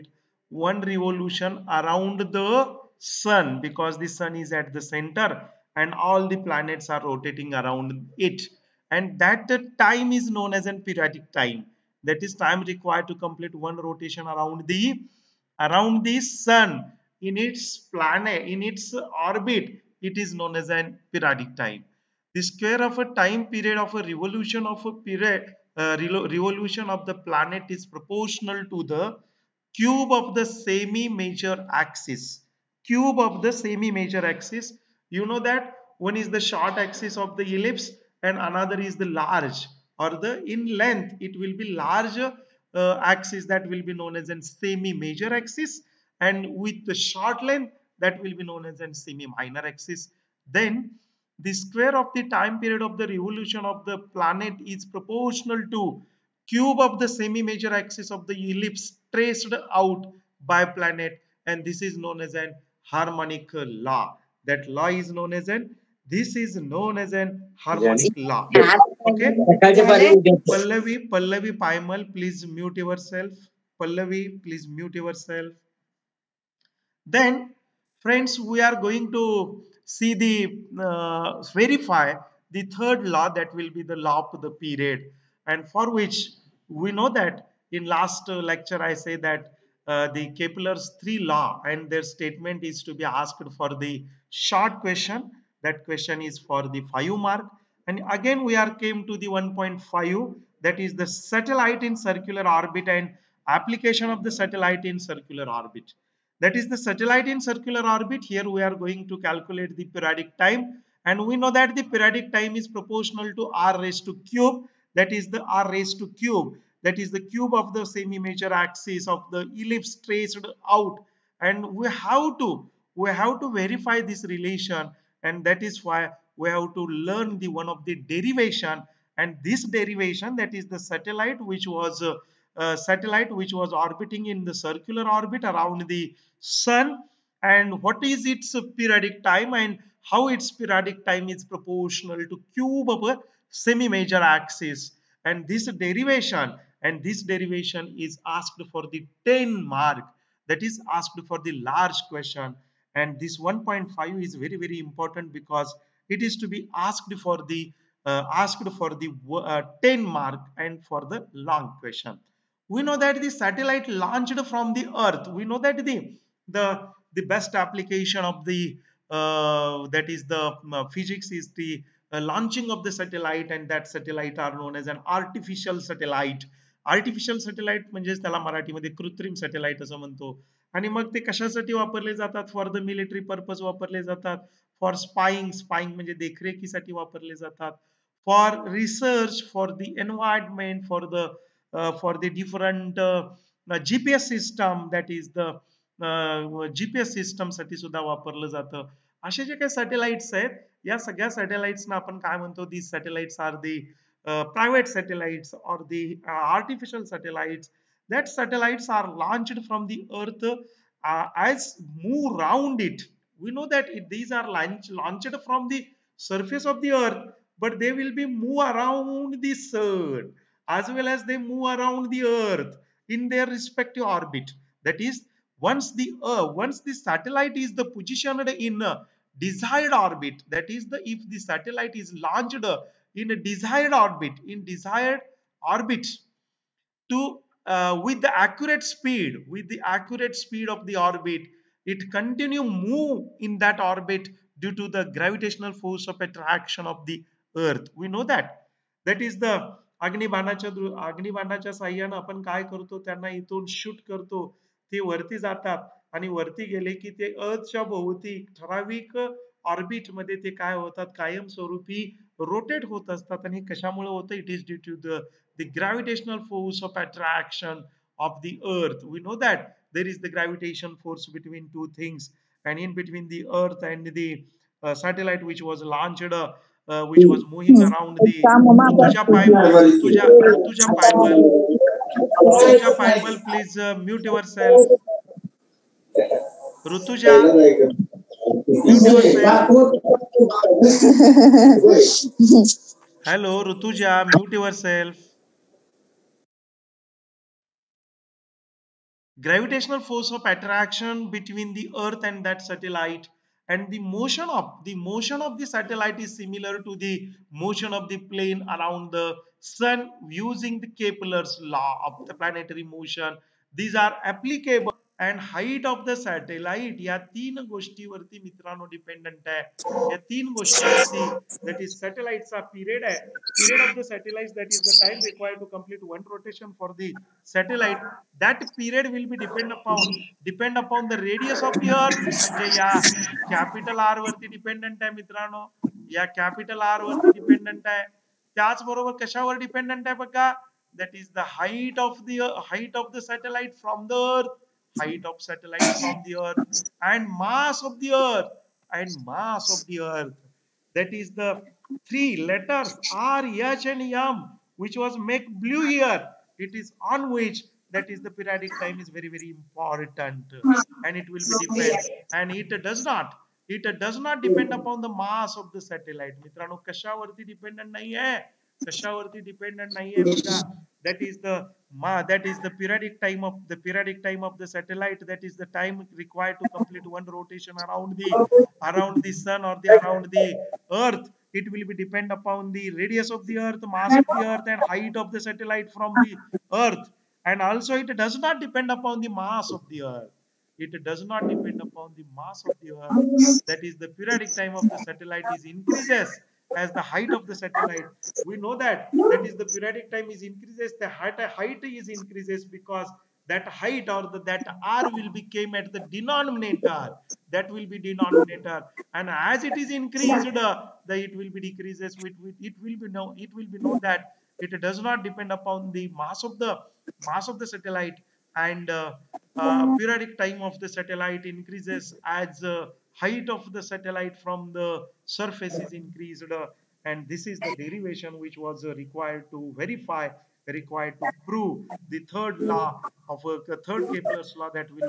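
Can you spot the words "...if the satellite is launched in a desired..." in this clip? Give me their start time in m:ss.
3:51.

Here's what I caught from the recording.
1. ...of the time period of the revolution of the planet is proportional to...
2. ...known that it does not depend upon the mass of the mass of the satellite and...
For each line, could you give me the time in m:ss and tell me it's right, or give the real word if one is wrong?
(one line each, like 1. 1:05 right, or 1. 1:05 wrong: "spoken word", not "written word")
1. 0:51 right
2. 6:53 right.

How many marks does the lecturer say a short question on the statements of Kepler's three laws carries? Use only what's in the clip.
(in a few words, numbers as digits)
5.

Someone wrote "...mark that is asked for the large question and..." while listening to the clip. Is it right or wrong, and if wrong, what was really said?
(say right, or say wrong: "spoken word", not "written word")
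right.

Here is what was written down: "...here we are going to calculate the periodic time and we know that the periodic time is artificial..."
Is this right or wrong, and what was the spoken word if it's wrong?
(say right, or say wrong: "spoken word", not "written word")
wrong: "proportional", not "artificial".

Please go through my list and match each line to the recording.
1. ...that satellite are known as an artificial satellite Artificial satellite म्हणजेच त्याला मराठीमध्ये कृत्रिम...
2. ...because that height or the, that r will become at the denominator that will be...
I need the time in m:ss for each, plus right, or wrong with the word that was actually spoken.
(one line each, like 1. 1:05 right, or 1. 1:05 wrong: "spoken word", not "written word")
1. 2:53 right
2. 6:42 right.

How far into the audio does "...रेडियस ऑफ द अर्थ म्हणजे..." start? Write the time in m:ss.
5:31.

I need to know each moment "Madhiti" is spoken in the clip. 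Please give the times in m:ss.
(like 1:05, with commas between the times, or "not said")
4:20.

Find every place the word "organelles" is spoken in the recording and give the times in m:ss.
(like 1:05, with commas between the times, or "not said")
not said.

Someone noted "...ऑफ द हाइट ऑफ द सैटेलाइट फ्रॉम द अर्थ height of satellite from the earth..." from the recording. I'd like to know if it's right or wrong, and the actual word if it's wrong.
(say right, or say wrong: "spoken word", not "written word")
right.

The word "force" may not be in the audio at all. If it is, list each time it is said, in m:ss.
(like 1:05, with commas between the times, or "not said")
4:05, 4:26, 4:31, 4:59.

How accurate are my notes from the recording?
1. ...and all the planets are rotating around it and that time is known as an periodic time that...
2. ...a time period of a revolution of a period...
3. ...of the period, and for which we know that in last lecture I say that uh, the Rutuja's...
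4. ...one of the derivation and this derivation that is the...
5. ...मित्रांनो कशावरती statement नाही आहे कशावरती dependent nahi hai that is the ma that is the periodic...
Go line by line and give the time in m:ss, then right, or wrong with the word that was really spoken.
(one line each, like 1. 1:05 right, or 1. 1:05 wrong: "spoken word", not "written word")
1. 0:05 right
2. 0:23 right
3. 1:24 wrong: "Kepler", not "Rutuja"
4. 2:07 right
5. 6:06 wrong: "dependent", not "statement".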